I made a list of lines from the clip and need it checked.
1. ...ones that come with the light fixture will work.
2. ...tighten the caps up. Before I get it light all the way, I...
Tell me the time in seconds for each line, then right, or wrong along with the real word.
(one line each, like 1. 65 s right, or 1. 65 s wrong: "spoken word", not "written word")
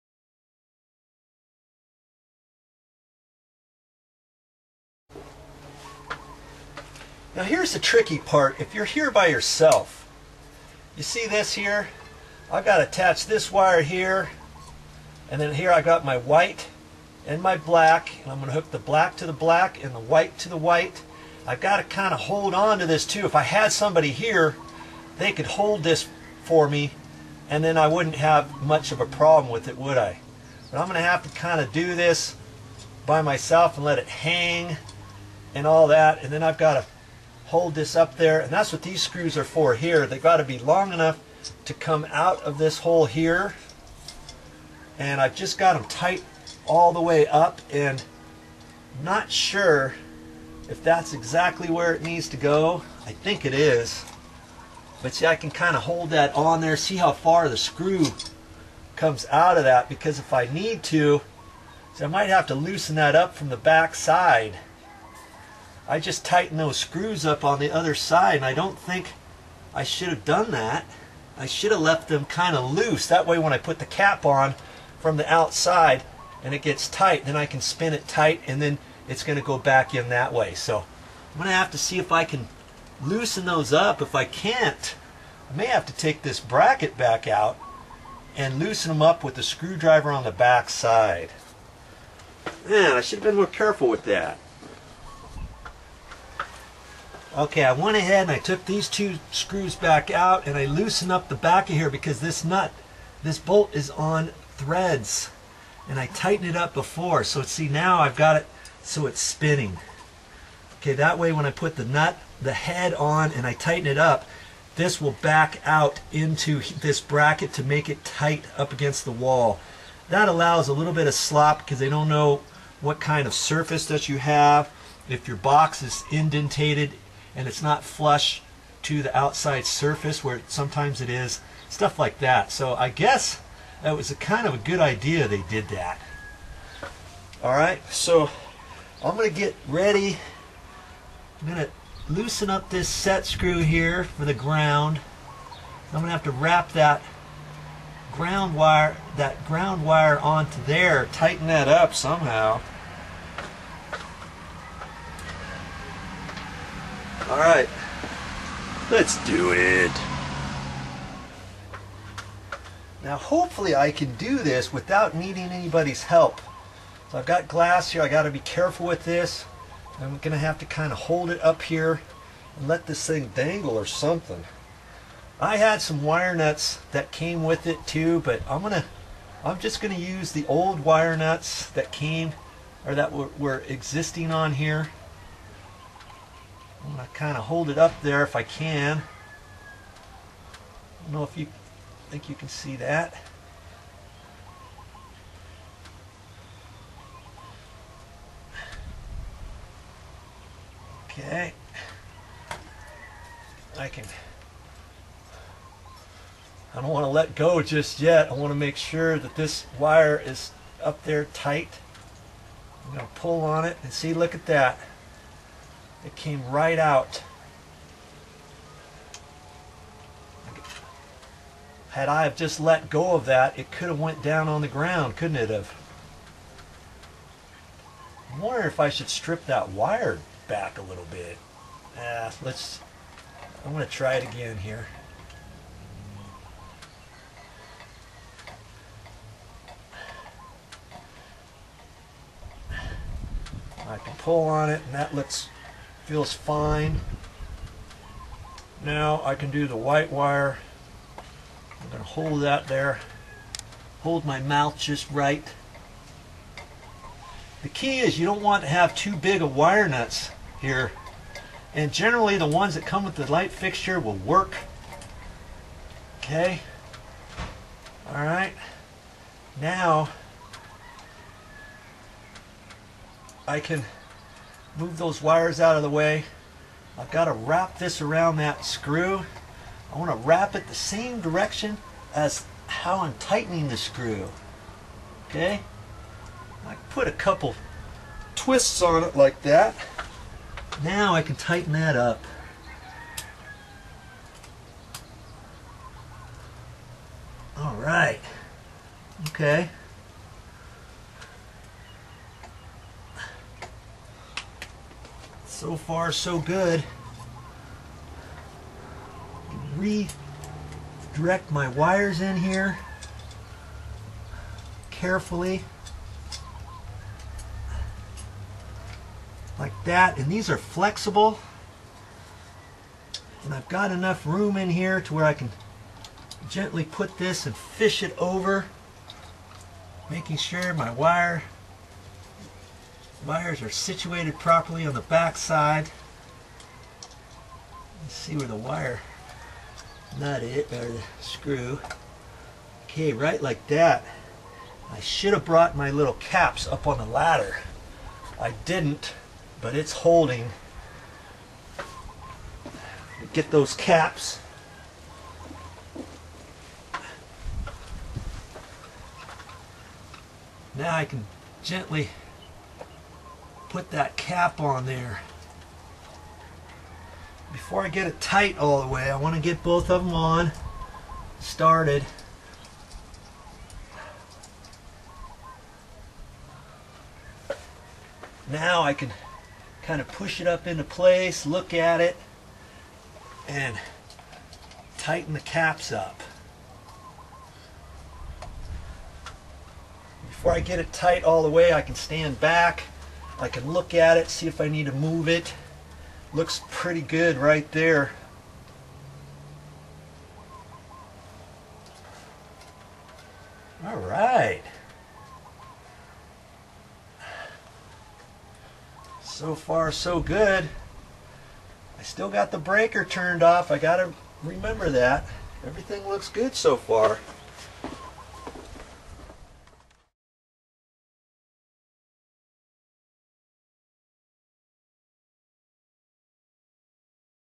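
1. 262 s right
2. 384 s wrong: "tight", not "light".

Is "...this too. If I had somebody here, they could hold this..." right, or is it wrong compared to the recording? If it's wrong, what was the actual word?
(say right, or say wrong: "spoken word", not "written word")
right.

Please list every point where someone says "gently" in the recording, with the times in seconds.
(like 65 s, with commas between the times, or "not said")
326 s, 361 s.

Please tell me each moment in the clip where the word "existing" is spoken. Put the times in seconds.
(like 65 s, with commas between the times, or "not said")
183 s.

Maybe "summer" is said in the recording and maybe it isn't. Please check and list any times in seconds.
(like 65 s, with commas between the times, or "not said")
not said.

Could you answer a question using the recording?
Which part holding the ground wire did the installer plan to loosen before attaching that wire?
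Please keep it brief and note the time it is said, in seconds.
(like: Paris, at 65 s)
set screw, at 142 s.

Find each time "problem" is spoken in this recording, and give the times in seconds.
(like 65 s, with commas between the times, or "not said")
29 s.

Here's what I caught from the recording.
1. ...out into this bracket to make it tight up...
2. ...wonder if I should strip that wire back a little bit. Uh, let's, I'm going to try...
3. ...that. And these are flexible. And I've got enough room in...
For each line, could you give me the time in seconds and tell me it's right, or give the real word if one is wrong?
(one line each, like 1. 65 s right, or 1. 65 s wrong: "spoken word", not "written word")
1. 115 s right
2. 228 s right
3. 319 s right.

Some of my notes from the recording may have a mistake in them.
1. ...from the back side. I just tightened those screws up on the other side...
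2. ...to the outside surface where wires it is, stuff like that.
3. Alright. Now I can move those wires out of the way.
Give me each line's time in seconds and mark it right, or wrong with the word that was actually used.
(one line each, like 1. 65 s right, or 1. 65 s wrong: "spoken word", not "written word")
1. 63 s right
2. 128 s wrong: "sometimes", not "wires"
3. 268 s right.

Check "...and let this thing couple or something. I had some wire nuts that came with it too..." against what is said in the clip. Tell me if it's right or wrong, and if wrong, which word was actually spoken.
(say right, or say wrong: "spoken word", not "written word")
wrong: "dangle", not "couple".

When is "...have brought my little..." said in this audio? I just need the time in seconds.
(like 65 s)
345 s.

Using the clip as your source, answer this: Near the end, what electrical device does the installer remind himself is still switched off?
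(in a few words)
the breaker.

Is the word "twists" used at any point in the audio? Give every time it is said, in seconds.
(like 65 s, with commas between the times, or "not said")
288 s.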